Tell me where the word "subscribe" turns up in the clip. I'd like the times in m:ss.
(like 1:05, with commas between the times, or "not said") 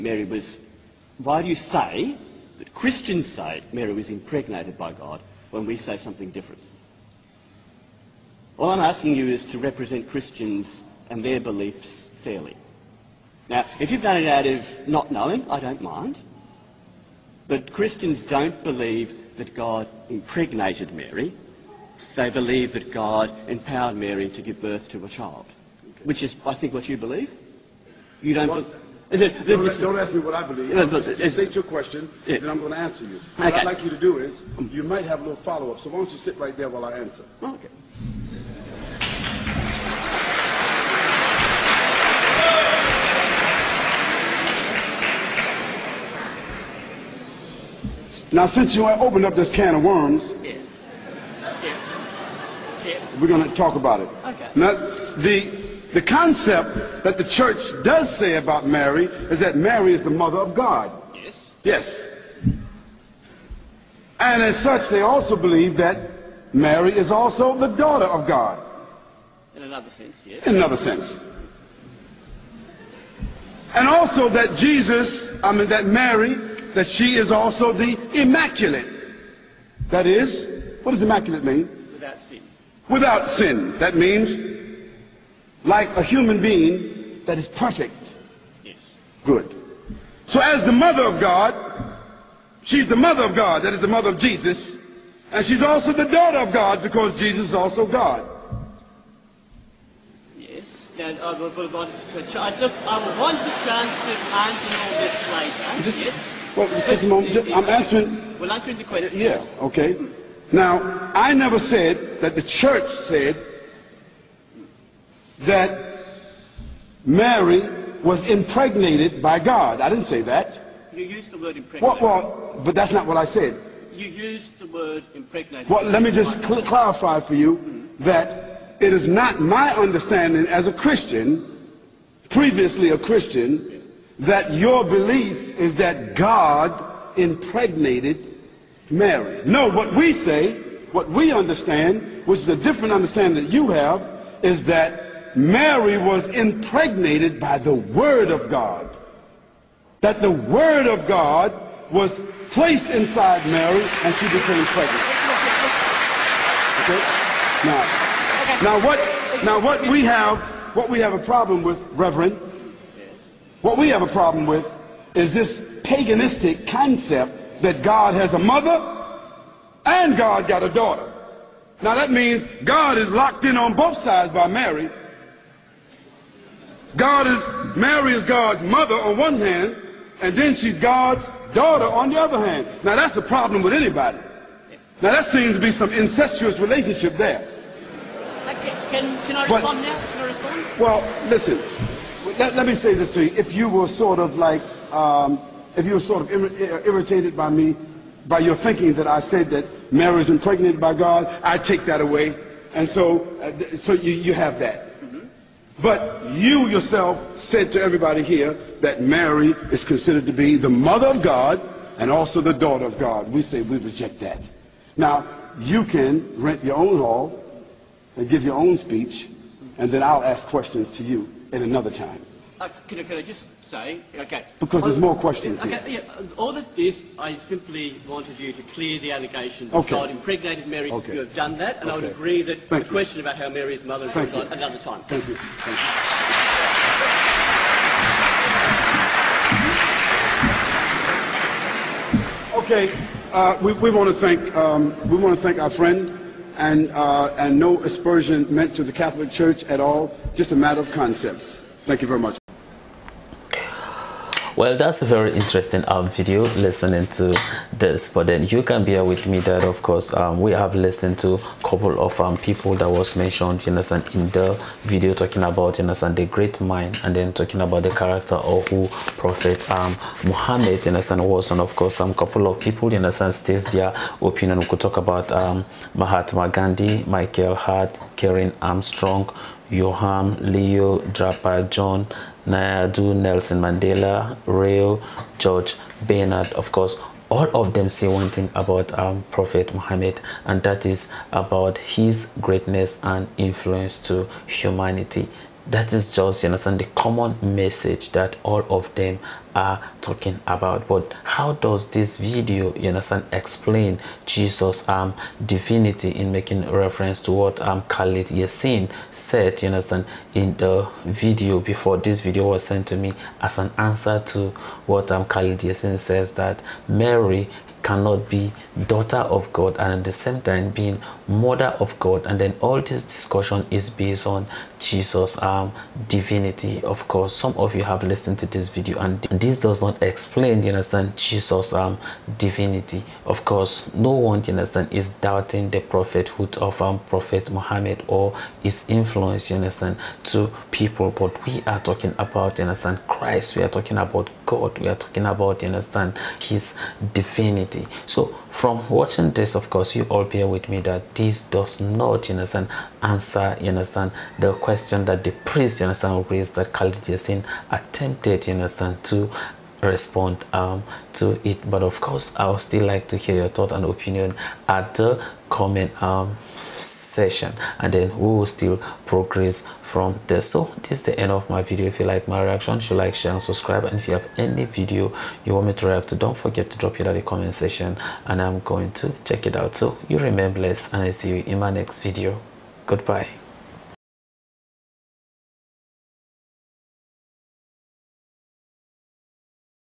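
6:13.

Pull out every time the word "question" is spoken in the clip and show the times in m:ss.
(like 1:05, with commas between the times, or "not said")
0:31, 1:48, 3:40, 3:45, 3:52, 5:54.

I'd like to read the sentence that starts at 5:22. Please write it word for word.
And then all this discussion is based on Jesus' um, divinity.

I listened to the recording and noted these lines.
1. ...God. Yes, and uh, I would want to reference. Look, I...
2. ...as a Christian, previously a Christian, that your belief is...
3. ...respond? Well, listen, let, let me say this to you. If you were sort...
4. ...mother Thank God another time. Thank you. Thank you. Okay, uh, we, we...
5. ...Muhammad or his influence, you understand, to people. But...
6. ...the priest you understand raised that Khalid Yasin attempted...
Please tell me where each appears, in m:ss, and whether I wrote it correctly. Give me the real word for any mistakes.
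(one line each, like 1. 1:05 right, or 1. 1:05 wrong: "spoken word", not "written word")
1. 1:37 wrong: "chance", not "reference"
2. 2:10 right
3. 3:10 right
4. 3:53 right
5. 5:37 right
6. 5:55 right.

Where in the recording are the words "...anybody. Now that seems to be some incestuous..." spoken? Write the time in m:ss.
3:03.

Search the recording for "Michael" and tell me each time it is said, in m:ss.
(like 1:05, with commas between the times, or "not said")
4:37.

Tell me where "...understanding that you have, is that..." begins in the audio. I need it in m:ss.
2:22.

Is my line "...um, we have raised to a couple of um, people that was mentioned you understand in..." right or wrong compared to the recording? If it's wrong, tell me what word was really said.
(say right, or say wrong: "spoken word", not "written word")
wrong: "listened", not "raised".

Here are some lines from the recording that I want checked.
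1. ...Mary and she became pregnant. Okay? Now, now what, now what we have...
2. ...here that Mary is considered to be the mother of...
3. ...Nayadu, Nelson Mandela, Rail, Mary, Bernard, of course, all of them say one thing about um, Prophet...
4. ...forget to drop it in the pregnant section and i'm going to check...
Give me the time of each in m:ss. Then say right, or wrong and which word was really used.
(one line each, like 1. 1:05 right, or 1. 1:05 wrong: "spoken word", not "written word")
1. 2:33 right
2. 3:28 right
3. 4:42 wrong: "George", not "Mary"
4. 6:16 wrong: "comment", not "pregnant".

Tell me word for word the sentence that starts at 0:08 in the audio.
All I'm asking you is to represent Christians and their beliefs fairly.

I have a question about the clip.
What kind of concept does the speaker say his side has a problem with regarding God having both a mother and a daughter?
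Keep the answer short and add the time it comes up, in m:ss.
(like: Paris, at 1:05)
Paganistic, at 2:45.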